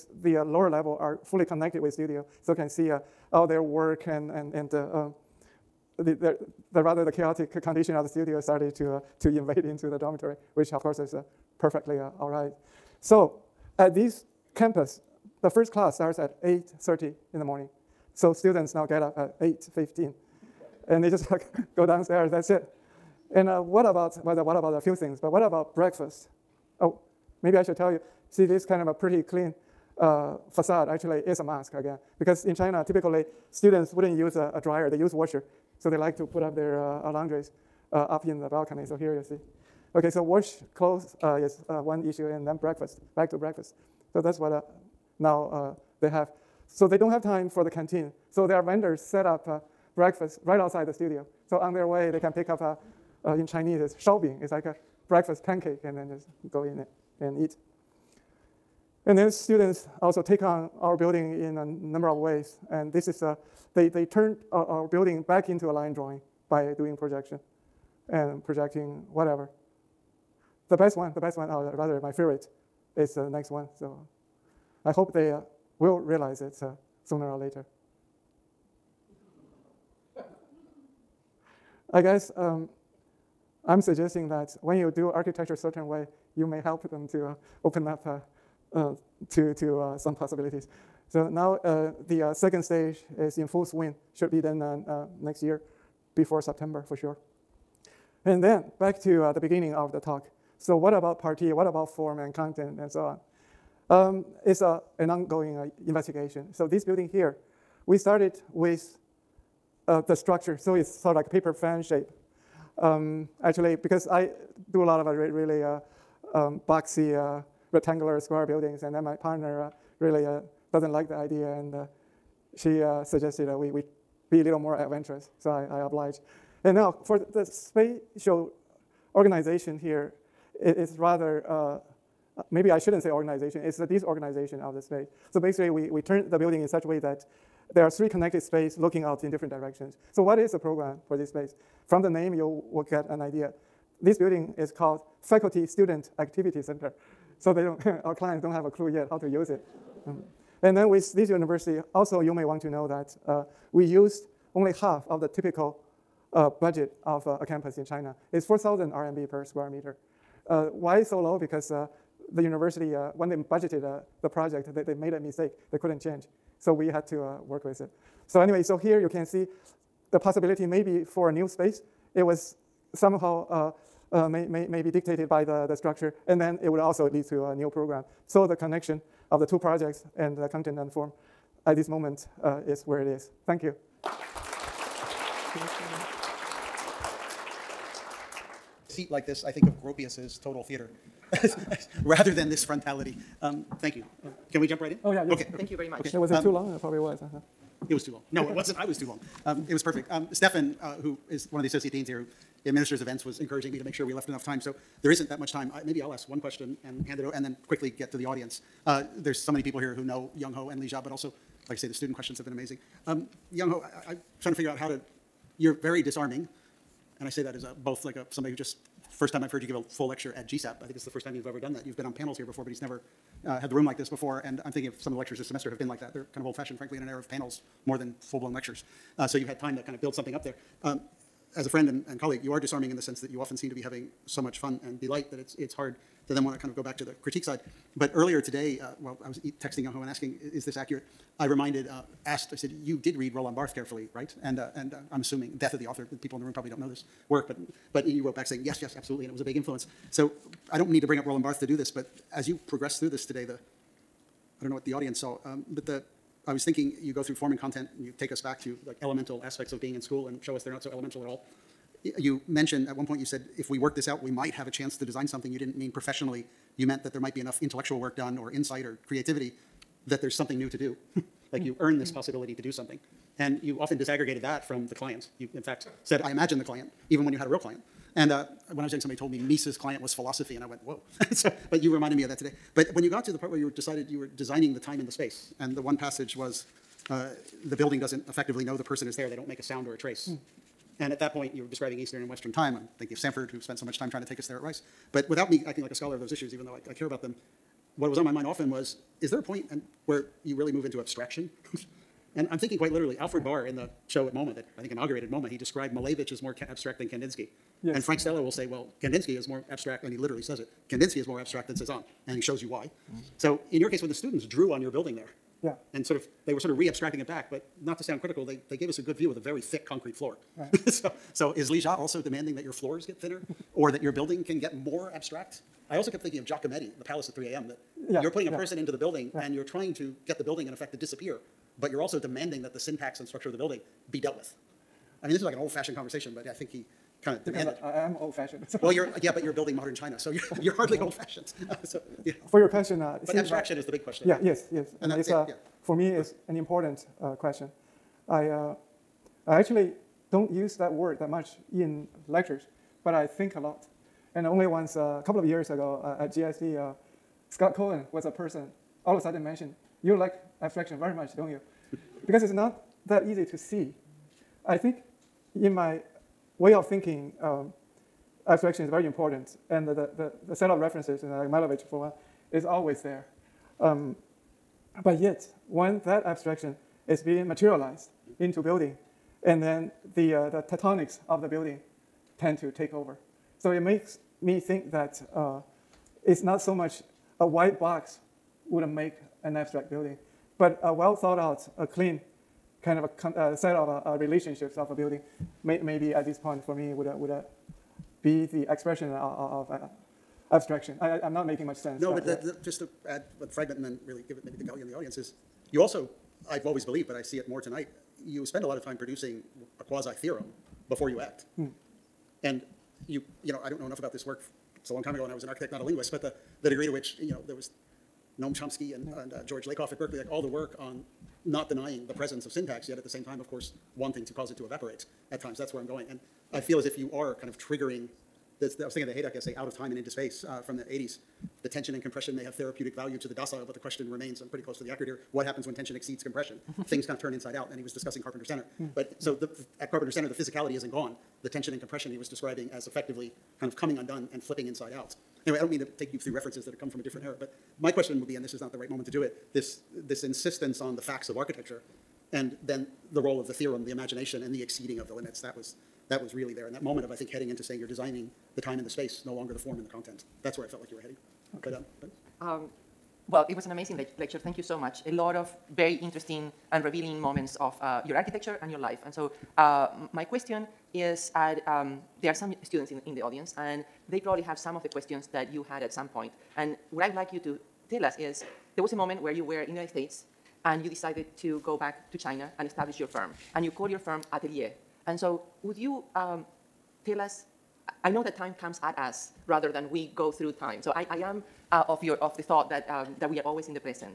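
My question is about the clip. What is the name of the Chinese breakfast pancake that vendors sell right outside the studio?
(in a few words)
shoubing.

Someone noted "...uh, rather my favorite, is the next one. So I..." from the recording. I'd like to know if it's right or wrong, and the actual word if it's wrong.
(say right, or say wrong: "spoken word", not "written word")
right.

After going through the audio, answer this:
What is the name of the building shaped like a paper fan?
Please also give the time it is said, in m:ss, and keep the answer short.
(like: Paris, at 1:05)
Faculty Student Activity Center, at 2:25.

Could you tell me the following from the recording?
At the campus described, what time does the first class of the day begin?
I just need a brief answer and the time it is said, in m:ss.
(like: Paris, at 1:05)
8:30, at 0:16.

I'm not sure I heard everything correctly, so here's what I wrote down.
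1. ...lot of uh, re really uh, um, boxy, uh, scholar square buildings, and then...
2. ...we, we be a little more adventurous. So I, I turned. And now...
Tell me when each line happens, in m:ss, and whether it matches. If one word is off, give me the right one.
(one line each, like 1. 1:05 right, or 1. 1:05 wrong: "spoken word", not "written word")
1. 1:54 wrong: "rectangular", not "scholar"
2. 2:03 wrong: "obliged", not "turned".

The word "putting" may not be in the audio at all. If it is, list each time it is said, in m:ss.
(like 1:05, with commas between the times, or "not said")
5:28.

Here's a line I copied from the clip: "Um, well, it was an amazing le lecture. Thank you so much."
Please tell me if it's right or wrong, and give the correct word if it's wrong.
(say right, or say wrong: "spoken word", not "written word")
right.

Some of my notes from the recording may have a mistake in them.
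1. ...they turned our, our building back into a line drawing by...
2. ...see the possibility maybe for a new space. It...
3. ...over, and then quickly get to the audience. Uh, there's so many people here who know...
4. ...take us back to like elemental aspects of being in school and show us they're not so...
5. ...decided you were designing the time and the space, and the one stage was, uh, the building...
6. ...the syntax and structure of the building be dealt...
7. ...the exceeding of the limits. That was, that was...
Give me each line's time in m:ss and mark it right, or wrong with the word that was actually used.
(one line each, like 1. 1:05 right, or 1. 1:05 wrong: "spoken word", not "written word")
1. 1:03 right
2. 2:49 right
3. 3:27 right
4. 4:18 right
5. 4:43 wrong: "passage", not "stage"
6. 5:32 right
7. 7:34 right.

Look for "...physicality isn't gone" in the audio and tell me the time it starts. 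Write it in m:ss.
7:20.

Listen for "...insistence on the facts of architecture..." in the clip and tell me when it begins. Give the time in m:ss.
7:30.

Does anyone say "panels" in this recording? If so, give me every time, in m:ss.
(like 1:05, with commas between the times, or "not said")
3:42, 3:47.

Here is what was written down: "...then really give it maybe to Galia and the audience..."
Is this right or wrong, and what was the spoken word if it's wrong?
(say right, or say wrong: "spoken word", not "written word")
right.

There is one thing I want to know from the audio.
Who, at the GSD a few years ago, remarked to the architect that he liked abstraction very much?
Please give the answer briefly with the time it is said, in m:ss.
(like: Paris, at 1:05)
Scott Cohen, at 5:57.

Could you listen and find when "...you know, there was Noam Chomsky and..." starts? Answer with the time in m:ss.
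6:57.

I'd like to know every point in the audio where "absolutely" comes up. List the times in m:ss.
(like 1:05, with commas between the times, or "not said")
4:08.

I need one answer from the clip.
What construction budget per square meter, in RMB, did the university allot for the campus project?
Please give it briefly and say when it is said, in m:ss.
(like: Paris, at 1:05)
4,000 RMB, at 2:38.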